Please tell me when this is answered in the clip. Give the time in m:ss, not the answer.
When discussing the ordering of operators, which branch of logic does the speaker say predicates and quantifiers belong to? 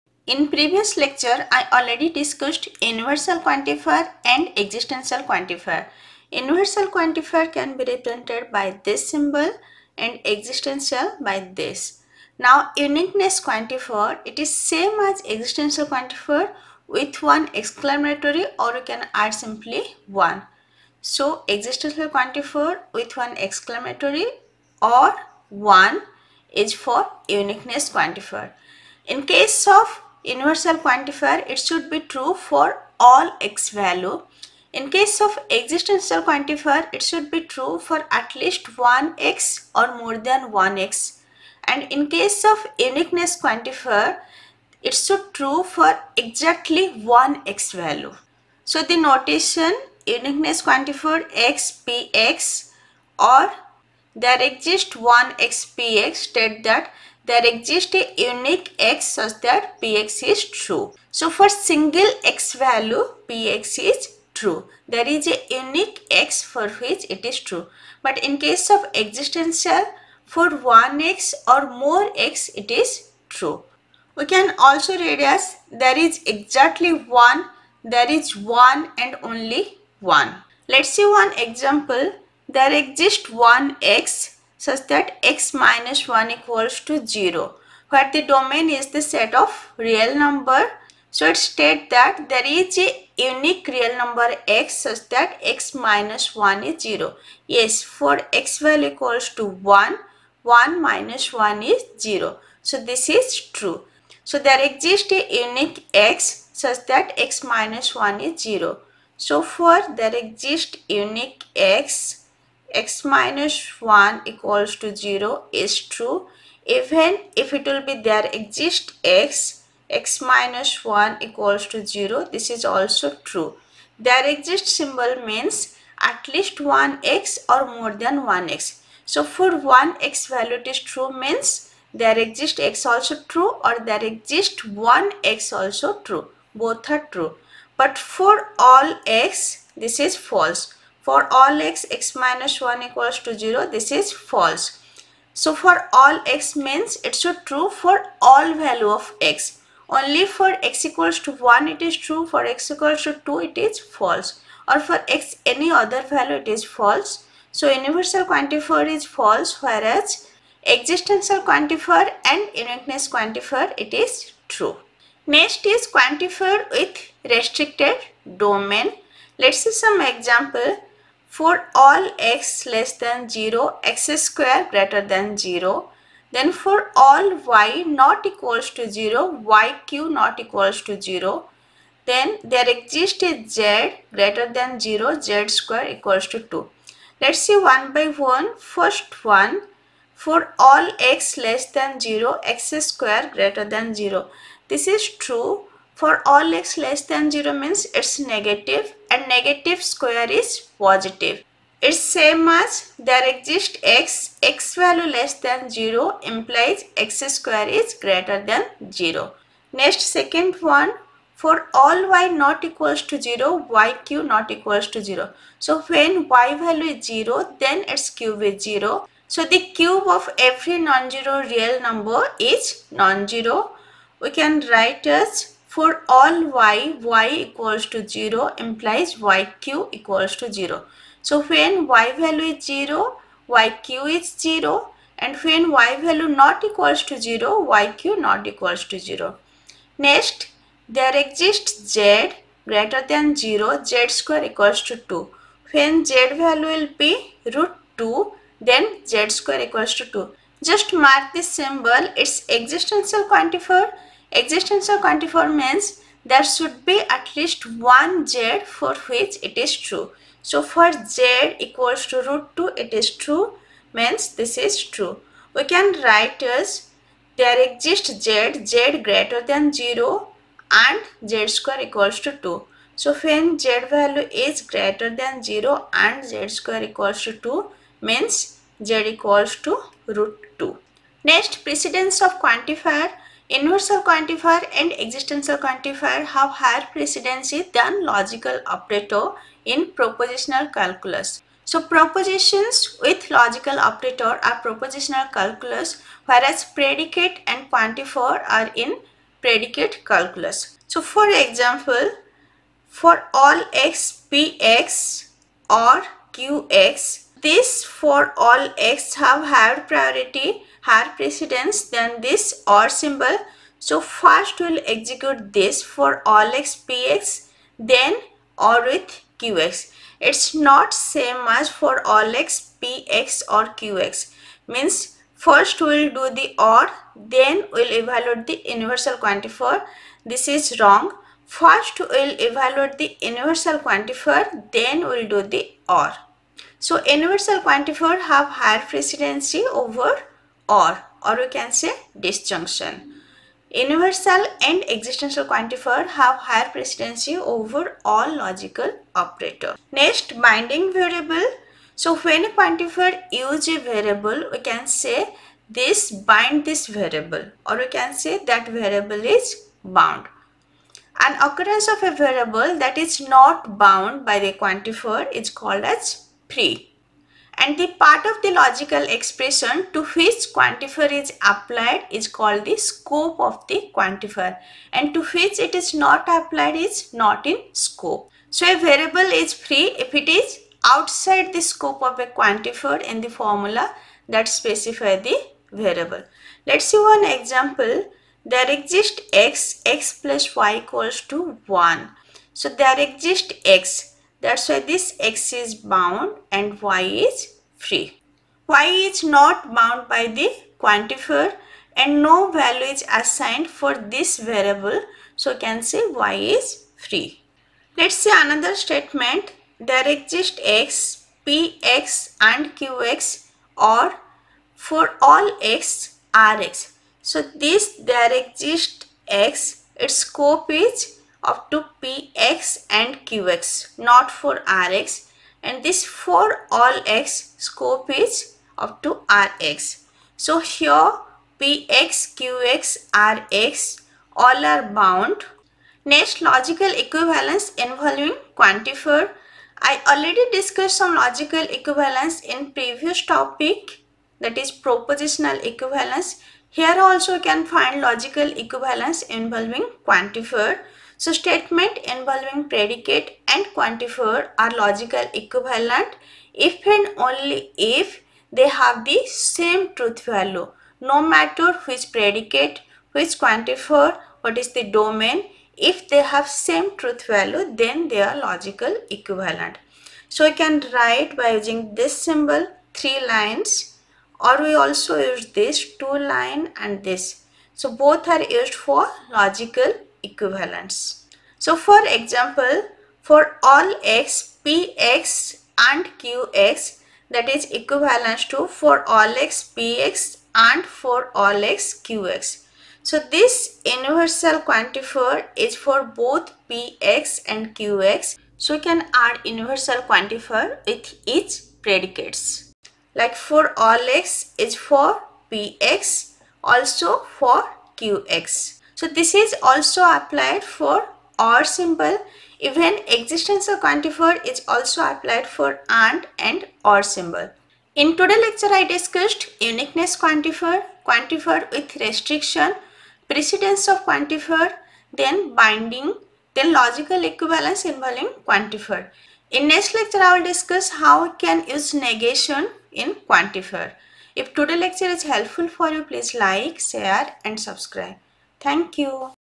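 4:59.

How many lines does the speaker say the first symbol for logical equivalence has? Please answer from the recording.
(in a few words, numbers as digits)
3.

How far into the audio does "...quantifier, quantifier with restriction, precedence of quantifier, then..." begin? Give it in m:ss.
8:40.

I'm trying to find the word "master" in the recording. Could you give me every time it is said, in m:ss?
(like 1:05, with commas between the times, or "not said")
not said.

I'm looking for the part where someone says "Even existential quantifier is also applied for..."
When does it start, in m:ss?
8:32.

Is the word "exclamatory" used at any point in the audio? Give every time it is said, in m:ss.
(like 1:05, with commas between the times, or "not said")
0:17, 0:23.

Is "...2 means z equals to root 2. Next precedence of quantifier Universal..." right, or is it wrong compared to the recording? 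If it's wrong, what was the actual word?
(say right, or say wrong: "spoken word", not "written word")
right.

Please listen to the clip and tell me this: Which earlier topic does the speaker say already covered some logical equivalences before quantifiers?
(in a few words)
propositional equivalence.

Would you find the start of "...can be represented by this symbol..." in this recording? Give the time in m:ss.
0:07.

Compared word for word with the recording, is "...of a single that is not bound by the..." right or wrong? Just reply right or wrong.
wrong.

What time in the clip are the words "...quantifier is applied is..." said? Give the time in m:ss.
6:10.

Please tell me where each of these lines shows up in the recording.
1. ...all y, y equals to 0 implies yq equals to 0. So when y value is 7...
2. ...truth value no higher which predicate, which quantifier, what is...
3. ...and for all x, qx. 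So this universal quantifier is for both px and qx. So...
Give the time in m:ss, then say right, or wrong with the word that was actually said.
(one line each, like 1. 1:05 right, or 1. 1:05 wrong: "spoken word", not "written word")
1. 3:46 wrong: "0", not "7"
2. 7:39 wrong: "matter", not "higher"
3. 8:10 right.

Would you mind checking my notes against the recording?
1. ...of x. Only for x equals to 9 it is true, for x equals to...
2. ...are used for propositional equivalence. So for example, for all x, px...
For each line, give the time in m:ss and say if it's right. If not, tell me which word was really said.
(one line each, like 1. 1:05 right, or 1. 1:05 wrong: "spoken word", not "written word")
1. 2:28 wrong: "1", not "9"
2. 7:58 wrong: "logical", not "propositional".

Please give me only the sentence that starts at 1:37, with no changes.
Yes, for x value equals to 1, 1 minus 1 is 0.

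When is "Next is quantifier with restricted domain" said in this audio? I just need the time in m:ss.
2:45.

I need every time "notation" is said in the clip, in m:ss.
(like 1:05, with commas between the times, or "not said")
0:48.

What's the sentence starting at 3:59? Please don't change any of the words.
Next, there exists z greater than 0, z square equals to 2.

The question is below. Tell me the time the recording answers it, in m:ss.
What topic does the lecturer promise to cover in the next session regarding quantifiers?
8:51.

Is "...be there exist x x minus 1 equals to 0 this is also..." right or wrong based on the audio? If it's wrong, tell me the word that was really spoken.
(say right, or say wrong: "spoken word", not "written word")
right.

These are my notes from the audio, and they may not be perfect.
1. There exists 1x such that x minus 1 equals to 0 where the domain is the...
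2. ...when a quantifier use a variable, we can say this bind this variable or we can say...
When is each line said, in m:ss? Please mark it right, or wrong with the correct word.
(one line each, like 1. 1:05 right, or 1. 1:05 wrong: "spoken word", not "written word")
1. 1:22 right
2. 5:52 right.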